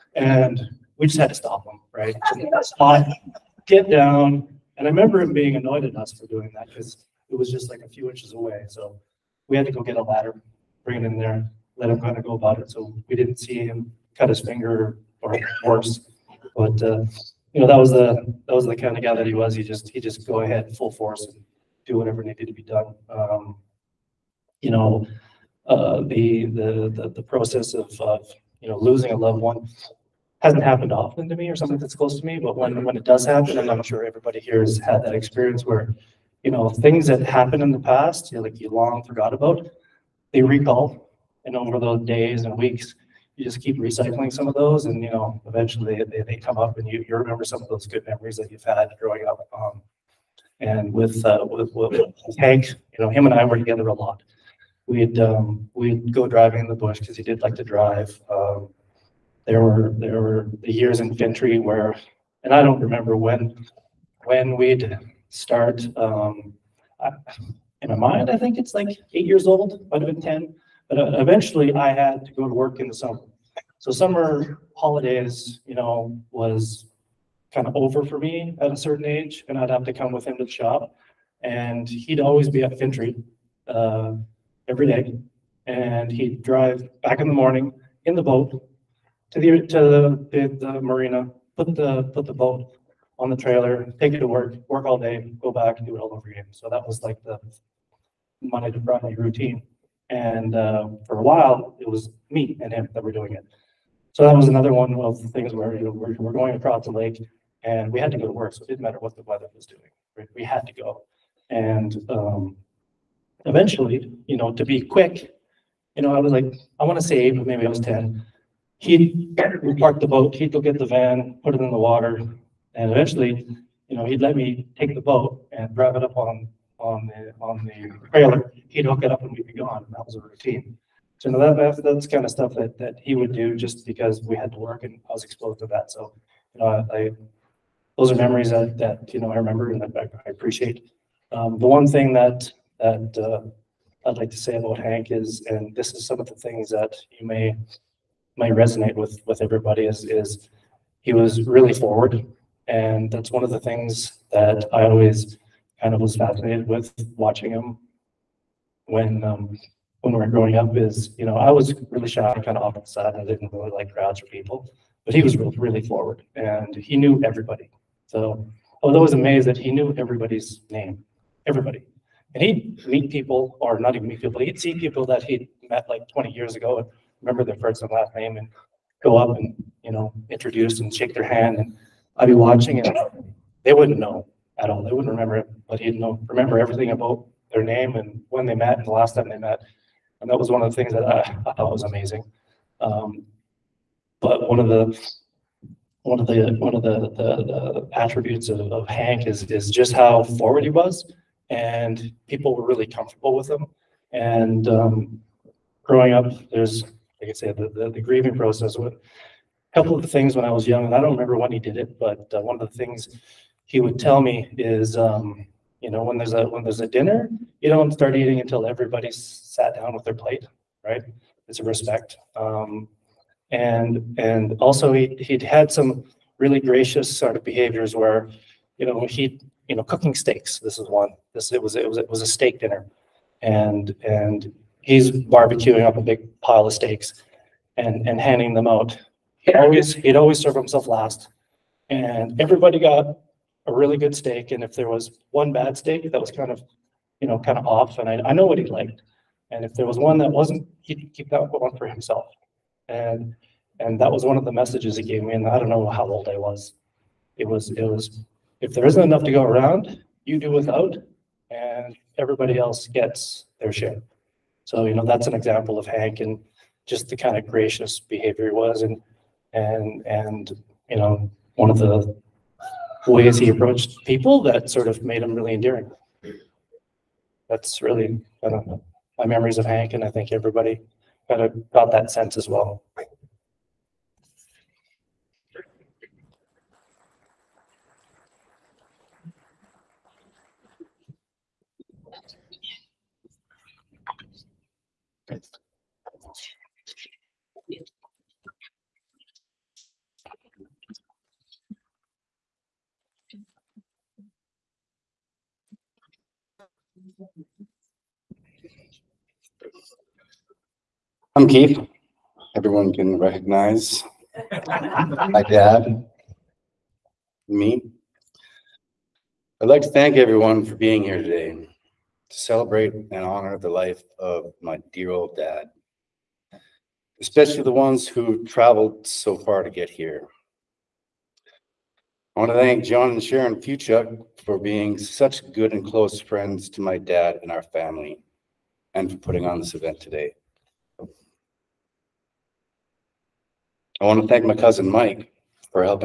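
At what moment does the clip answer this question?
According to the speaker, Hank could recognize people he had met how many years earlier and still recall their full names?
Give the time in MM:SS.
02:56.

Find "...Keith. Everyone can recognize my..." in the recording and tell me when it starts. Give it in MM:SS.
05:11.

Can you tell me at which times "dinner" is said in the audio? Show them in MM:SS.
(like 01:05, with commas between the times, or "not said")
03:36, 03:52.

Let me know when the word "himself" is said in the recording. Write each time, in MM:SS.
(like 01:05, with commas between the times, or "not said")
04:00, 04:11.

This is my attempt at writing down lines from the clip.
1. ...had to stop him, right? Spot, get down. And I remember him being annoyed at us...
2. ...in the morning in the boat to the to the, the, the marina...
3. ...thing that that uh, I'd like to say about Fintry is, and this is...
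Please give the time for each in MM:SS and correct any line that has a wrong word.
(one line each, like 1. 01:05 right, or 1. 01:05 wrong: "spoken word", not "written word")
1. 00:01 right
2. 01:27 right
3. 02:21 wrong: "Hank", not "Fintry".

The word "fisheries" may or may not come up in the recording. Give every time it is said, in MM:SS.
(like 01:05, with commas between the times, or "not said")
not said.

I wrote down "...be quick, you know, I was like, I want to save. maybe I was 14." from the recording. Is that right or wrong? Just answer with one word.
wrong.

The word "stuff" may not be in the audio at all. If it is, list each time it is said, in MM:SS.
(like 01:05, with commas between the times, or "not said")
02:12.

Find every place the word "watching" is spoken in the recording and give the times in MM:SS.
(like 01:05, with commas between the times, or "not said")
02:37, 03:02.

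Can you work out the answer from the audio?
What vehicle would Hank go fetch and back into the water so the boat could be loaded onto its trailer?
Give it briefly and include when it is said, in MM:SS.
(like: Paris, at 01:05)
van, at 02:00.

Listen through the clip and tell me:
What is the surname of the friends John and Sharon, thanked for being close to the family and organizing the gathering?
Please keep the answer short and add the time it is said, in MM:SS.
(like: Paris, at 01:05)
Fuchuk, at 05:33.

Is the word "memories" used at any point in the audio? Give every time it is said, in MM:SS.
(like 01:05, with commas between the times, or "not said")
00:48, 02:18, 04:39.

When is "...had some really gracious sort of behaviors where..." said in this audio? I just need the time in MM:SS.
03:45.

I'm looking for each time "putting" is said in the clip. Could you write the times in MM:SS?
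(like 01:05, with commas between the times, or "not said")
05:39.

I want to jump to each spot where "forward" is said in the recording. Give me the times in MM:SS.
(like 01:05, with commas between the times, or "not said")
02:31, 02:45, 03:20.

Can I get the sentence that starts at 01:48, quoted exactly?
So it didn't matter what the weather was doing.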